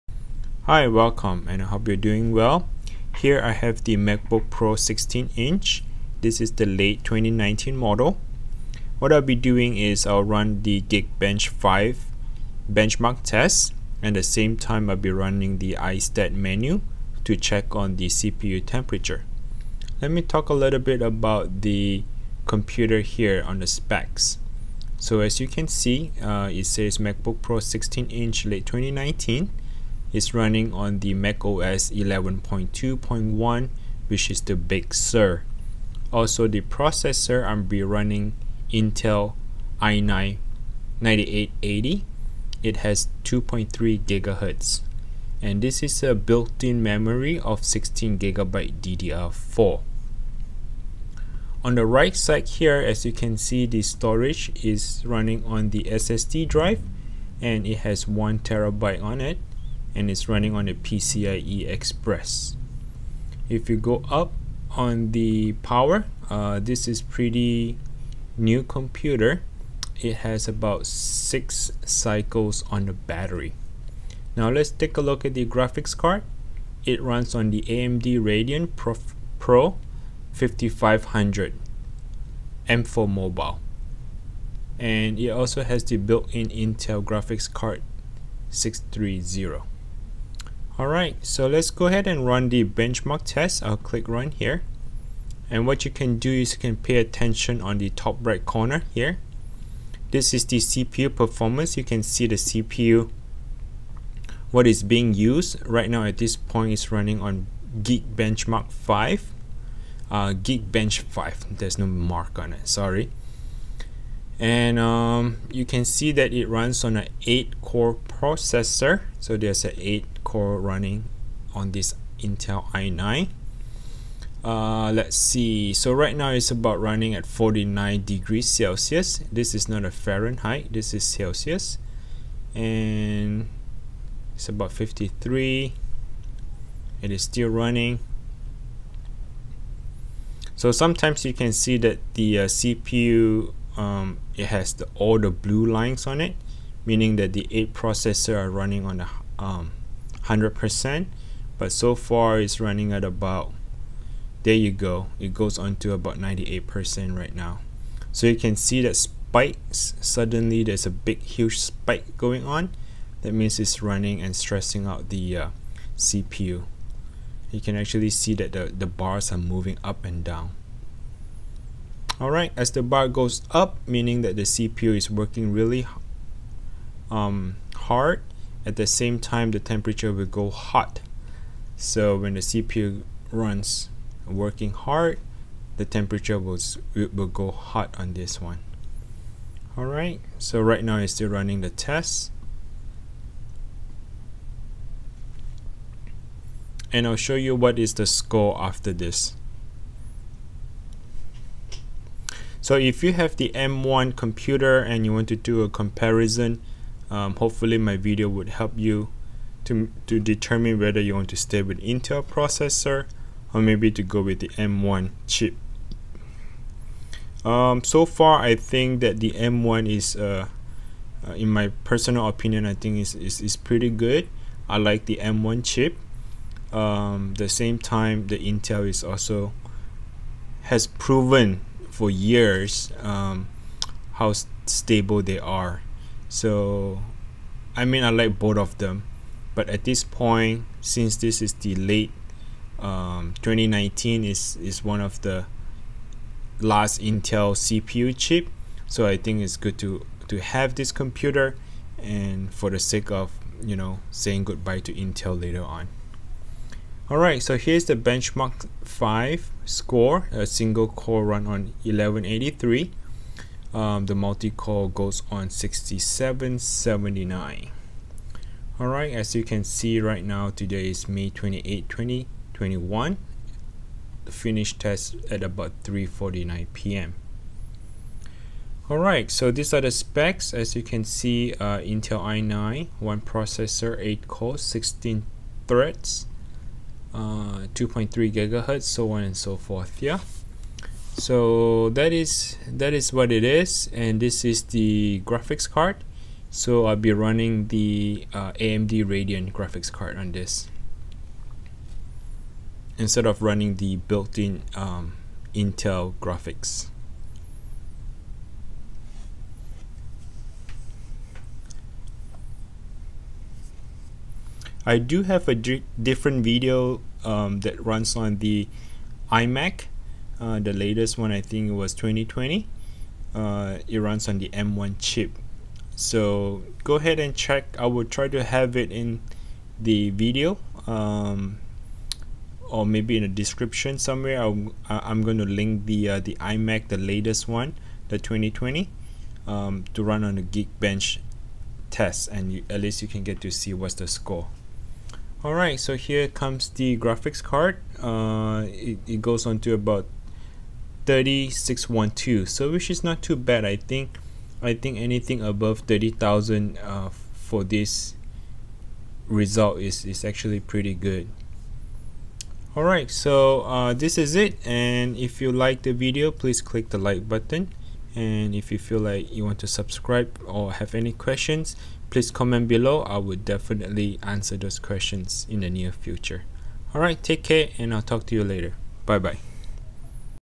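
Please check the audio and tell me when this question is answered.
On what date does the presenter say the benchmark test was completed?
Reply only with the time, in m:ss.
4:31.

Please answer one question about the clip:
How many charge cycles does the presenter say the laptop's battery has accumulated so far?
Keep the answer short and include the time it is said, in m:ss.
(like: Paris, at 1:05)
6, at 1:10.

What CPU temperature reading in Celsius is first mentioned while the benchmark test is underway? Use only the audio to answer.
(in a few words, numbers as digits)
49 degrees Celsius.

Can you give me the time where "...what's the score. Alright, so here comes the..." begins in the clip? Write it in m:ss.
5:43.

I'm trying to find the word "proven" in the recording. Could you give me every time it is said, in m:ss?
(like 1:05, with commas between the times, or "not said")
3:50.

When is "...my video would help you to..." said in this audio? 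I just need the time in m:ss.
3:27.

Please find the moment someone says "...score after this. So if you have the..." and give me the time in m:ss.
3:18.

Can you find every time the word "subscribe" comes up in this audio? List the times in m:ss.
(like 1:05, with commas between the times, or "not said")
6:09.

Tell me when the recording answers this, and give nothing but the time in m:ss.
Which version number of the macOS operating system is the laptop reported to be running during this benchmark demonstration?
0:31.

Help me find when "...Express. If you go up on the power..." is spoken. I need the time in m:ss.
1:01.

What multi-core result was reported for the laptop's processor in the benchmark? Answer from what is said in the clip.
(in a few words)
6779.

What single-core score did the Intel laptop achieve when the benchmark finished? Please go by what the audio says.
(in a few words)
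1183.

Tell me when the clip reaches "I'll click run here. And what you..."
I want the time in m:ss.
1:33.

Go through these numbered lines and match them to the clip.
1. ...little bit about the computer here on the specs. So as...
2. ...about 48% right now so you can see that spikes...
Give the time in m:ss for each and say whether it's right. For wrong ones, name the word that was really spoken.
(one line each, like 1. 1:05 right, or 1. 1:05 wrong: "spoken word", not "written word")
1. 0:20 right
2. 2:35 wrong: "98", not "48".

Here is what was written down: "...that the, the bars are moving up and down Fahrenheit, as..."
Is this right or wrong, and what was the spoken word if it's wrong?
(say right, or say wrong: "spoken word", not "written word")
wrong: "Alright", not "Fahrenheit".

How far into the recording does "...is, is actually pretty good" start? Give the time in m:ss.
5:59.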